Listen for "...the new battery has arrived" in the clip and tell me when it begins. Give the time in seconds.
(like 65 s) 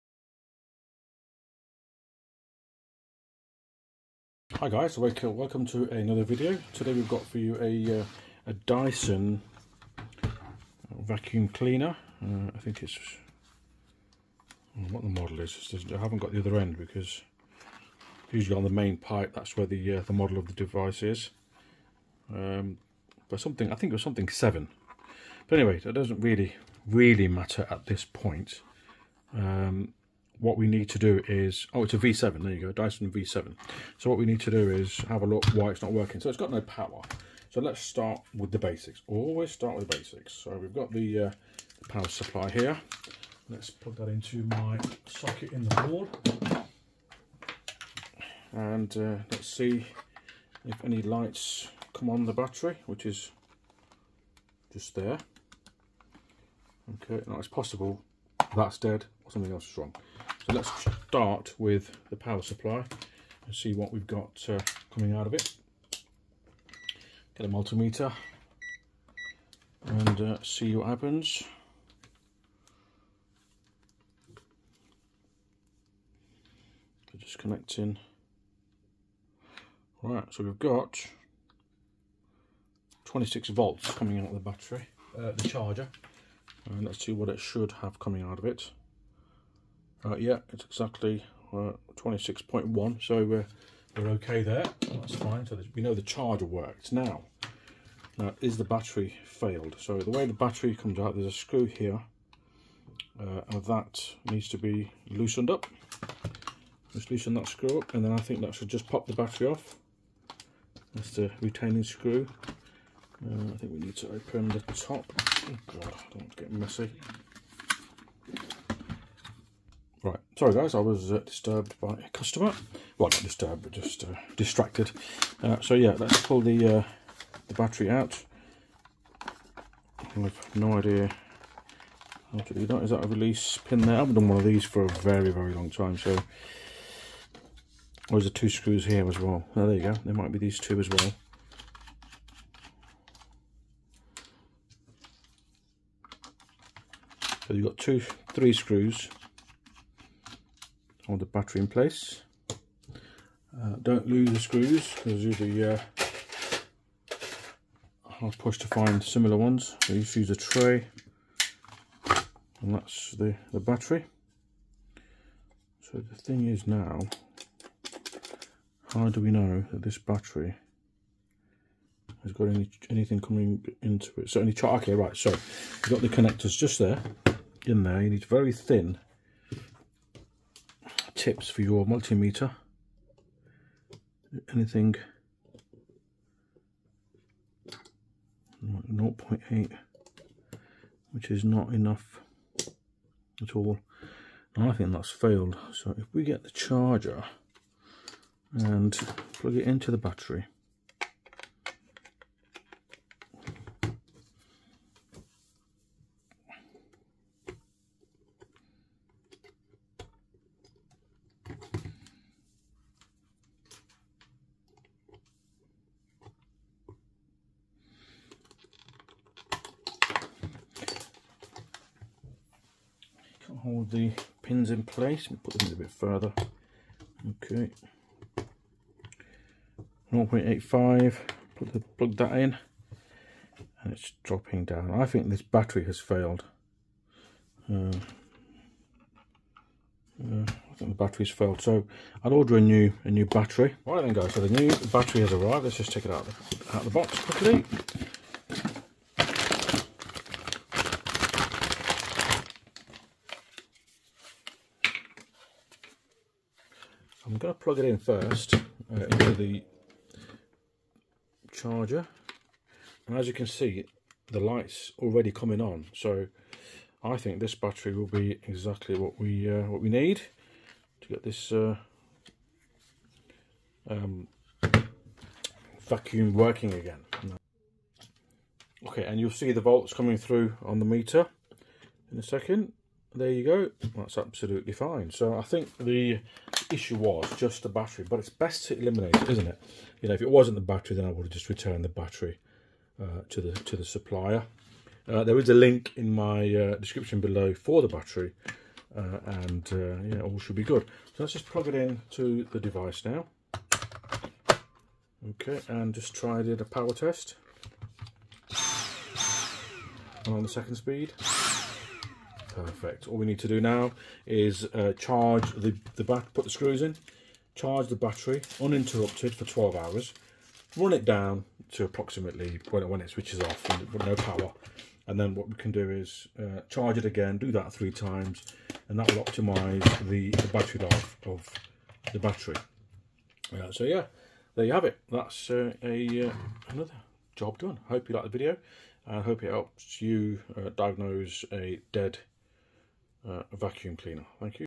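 244 s.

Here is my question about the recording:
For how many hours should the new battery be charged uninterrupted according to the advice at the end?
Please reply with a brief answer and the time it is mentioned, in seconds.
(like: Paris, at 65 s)
12, at 319 s.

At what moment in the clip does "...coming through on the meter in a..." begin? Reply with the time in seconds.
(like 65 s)
279 s.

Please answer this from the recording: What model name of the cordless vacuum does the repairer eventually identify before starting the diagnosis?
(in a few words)
Dyson V7.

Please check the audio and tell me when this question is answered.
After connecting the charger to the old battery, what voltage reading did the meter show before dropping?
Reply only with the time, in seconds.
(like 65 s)
230 s.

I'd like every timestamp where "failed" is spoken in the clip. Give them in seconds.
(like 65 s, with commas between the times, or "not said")
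99 s, 195 s, 235 s, 241 s.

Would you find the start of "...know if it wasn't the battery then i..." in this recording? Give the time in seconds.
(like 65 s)
290 s.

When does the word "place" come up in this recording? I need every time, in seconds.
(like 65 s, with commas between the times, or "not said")
151 s, 224 s.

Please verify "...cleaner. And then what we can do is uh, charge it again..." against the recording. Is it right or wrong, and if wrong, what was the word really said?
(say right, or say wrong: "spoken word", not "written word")
wrong: "power", not "cleaner".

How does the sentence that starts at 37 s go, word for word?
So let's start with the basics.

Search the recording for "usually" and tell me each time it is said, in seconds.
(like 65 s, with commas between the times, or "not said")
18 s.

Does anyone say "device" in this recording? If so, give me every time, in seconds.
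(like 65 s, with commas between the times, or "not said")
20 s, 302 s.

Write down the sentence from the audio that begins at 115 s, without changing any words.
Oh God, I don't want to get messy.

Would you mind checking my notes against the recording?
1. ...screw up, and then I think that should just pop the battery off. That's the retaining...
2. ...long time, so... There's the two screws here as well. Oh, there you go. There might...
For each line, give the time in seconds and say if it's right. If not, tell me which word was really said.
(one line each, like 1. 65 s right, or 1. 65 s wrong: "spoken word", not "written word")
1. 107 s right
2. 135 s right.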